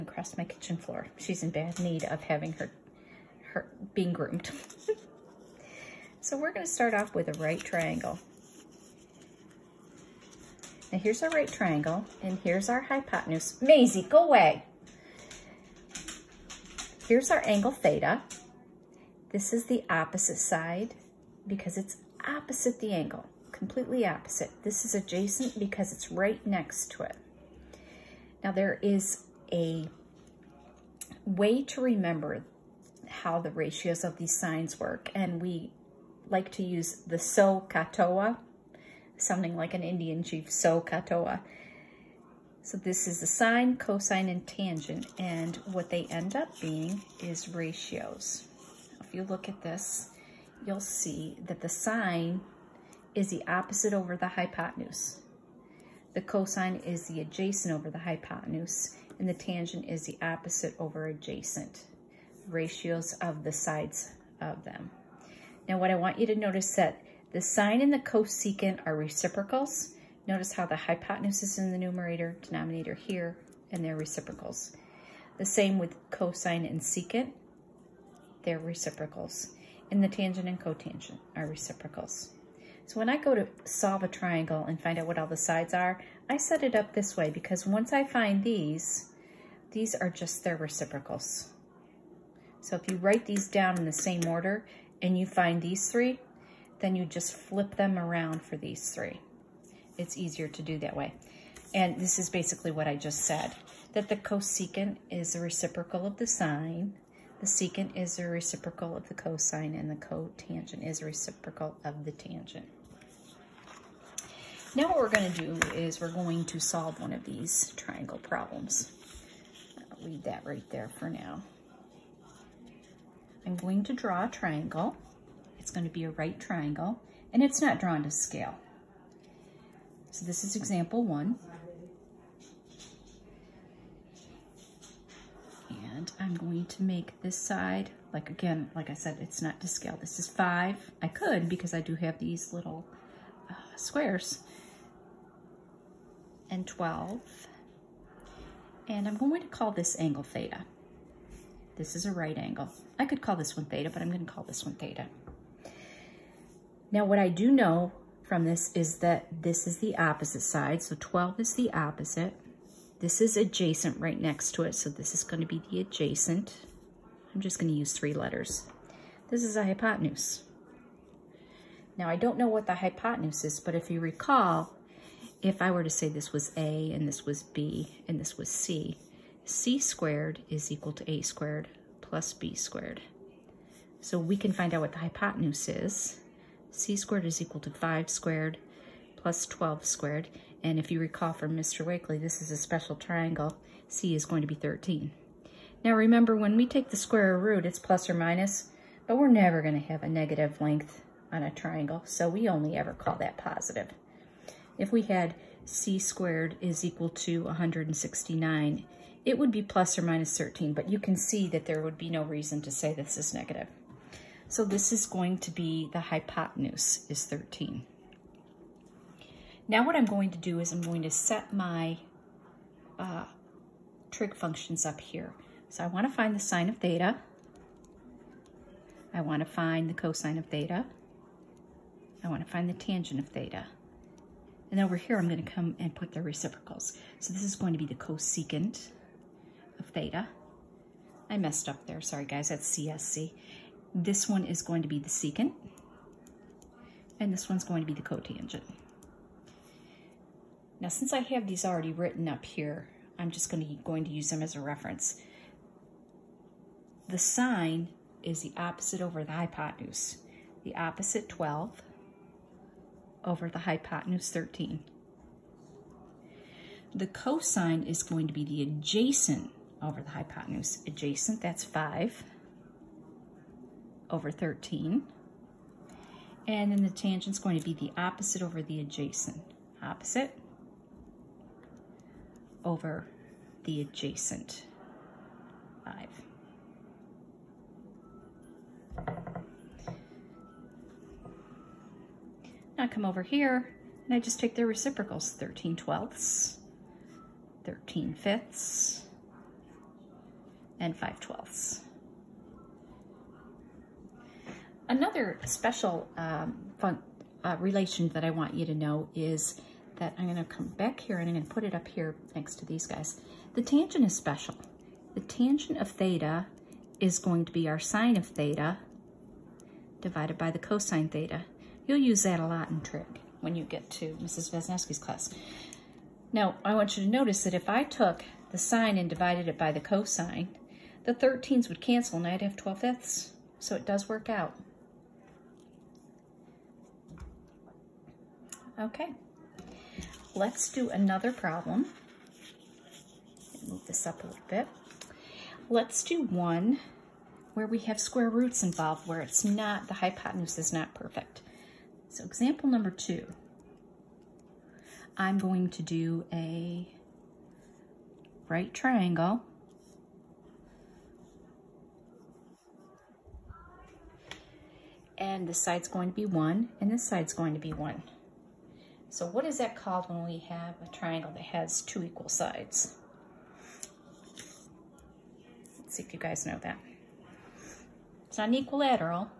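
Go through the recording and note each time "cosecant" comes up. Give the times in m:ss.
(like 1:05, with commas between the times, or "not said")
1:08, 1:44, 3:57.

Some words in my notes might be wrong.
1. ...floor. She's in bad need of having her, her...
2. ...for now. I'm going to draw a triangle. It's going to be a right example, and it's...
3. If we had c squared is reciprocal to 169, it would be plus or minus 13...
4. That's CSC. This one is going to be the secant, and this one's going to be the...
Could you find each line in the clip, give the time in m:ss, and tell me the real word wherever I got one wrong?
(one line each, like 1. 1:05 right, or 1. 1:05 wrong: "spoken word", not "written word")
1. 0:00 right
2. 2:00 wrong: "triangle", not "example"
3. 3:24 wrong: "equal", not "reciprocal"
4. 4:02 right.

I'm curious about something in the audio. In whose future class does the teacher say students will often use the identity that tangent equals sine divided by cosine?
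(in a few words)
Mrs. Vesnowski.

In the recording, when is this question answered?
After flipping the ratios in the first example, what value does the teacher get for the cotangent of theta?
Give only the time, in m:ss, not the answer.
5:00.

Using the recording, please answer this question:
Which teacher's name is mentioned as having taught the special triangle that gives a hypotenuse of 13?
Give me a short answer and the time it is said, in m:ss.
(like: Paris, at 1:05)
Mr. Wakely, at 3:11.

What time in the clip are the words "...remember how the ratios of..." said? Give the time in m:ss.
0:31.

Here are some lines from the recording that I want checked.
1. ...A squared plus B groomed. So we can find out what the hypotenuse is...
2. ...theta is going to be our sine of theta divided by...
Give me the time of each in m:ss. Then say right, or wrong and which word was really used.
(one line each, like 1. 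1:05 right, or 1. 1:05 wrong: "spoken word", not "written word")
1. 3:01 wrong: "squared", not "groomed"
2. 5:15 right.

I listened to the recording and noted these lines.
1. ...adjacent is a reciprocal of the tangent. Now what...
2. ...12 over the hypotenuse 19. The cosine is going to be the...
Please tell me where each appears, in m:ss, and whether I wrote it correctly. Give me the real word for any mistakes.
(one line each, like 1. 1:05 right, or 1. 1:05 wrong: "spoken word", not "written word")
1. 1:49 wrong: "cotangent", not "adjacent"
2. 4:21 wrong: "13", not "19".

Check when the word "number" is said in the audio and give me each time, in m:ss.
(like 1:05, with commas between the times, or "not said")
5:52.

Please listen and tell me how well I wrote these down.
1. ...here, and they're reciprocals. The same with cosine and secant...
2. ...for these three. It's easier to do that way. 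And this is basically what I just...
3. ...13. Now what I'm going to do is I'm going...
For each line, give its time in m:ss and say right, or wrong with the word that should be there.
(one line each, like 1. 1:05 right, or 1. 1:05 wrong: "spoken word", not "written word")
1. 1:12 right
2. 1:38 right
3. 3:37 right.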